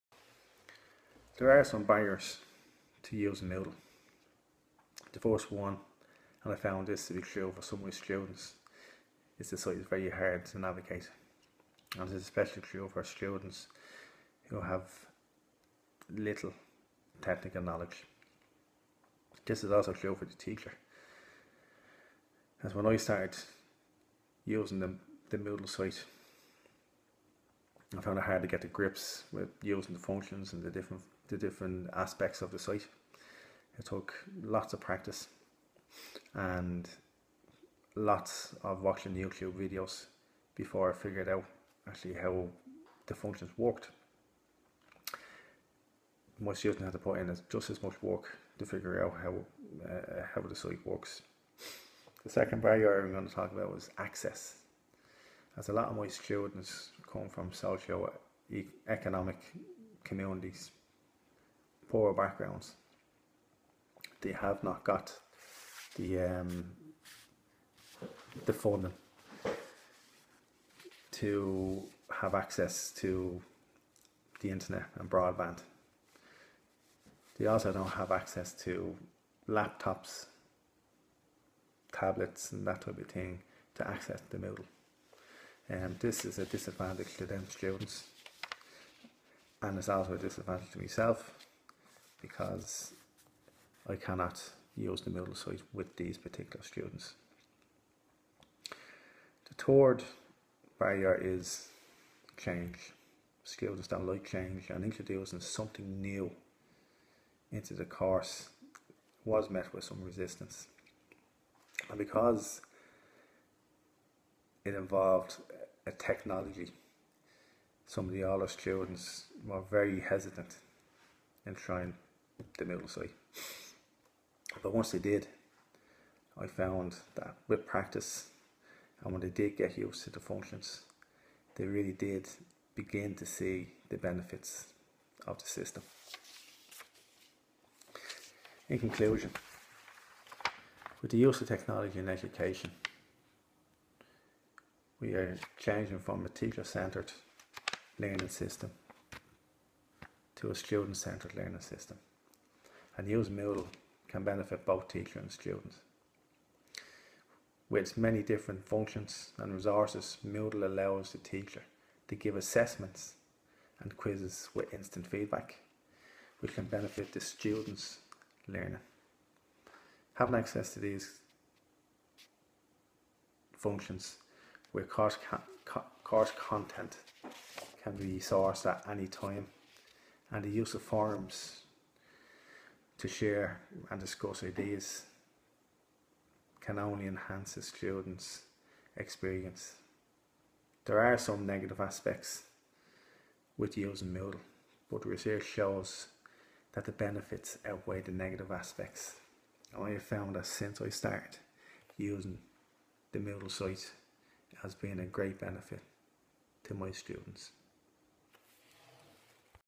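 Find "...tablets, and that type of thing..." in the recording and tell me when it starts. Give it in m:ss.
1:21.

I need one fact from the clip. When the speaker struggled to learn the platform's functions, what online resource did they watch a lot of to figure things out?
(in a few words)
YouTube videos.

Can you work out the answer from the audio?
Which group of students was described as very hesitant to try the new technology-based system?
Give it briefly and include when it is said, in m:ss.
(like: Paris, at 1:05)
older students, at 1:58.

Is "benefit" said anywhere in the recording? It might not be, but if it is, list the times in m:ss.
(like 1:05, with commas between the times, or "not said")
2:13, 2:34, 2:46, 3:16, 3:25.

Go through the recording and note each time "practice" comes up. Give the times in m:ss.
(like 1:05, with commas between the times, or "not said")
0:34, 2:07.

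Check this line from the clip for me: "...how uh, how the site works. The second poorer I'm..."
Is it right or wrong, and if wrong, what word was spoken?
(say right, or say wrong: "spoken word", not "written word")
wrong: "barrier", not "poorer".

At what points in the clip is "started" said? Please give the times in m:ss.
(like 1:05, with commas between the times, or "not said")
0:22, 3:20.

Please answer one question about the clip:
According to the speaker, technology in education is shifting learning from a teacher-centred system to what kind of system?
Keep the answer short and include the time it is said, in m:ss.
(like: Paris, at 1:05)
student-centred learning system, at 2:30.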